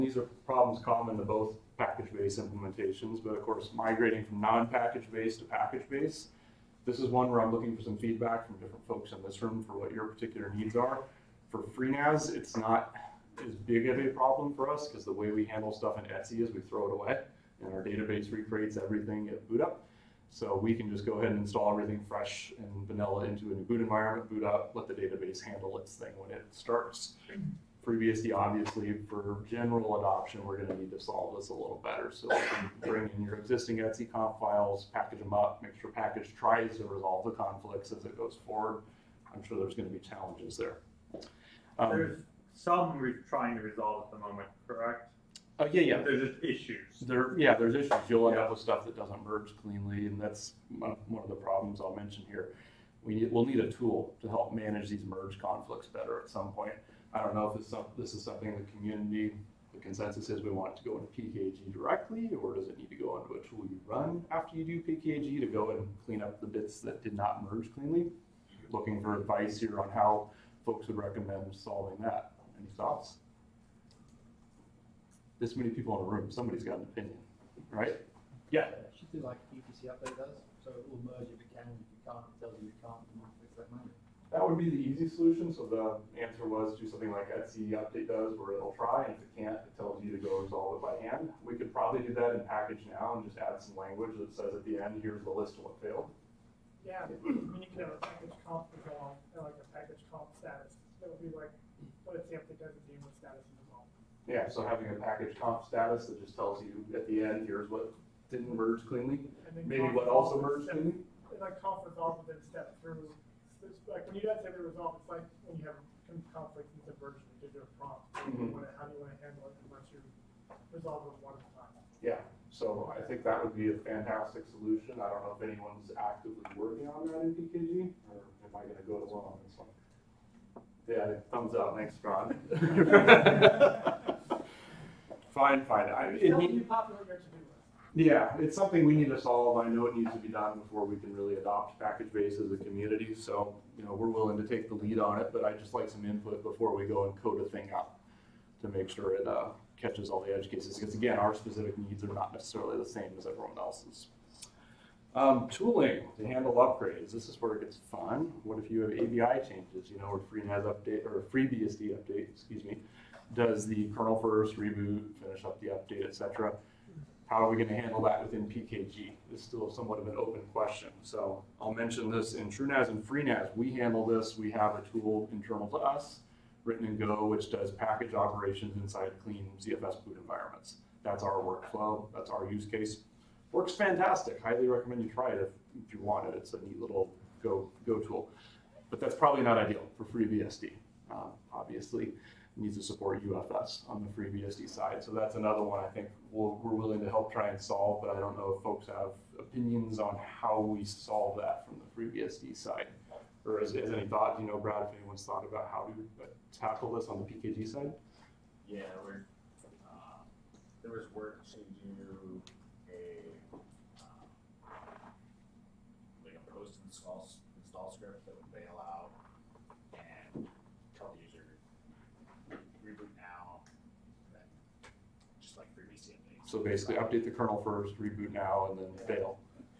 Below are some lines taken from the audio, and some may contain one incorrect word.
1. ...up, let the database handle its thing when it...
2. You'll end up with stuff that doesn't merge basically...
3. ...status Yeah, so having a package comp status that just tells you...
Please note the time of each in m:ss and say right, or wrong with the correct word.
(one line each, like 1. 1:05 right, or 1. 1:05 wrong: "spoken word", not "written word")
1. 0:24 right
2. 0:48 wrong: "cleanly", not "basically"
3. 1:43 right.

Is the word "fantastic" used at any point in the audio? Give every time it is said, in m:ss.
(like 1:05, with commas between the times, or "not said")
2:03, 3:03.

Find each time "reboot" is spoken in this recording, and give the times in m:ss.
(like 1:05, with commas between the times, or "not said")
2:44, 3:47.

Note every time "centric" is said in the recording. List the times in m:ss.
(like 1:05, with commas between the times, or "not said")
not said.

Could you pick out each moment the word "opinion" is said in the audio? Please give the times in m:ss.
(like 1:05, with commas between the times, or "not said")
1:16, 3:19.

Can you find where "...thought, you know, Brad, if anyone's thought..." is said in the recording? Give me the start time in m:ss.
3:24.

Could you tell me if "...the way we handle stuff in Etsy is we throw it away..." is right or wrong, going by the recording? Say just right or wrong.
right.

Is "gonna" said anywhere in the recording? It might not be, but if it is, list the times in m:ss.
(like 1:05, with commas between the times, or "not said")
2:08.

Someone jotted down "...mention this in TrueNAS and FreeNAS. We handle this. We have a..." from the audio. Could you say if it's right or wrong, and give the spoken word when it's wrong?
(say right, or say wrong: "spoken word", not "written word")
right.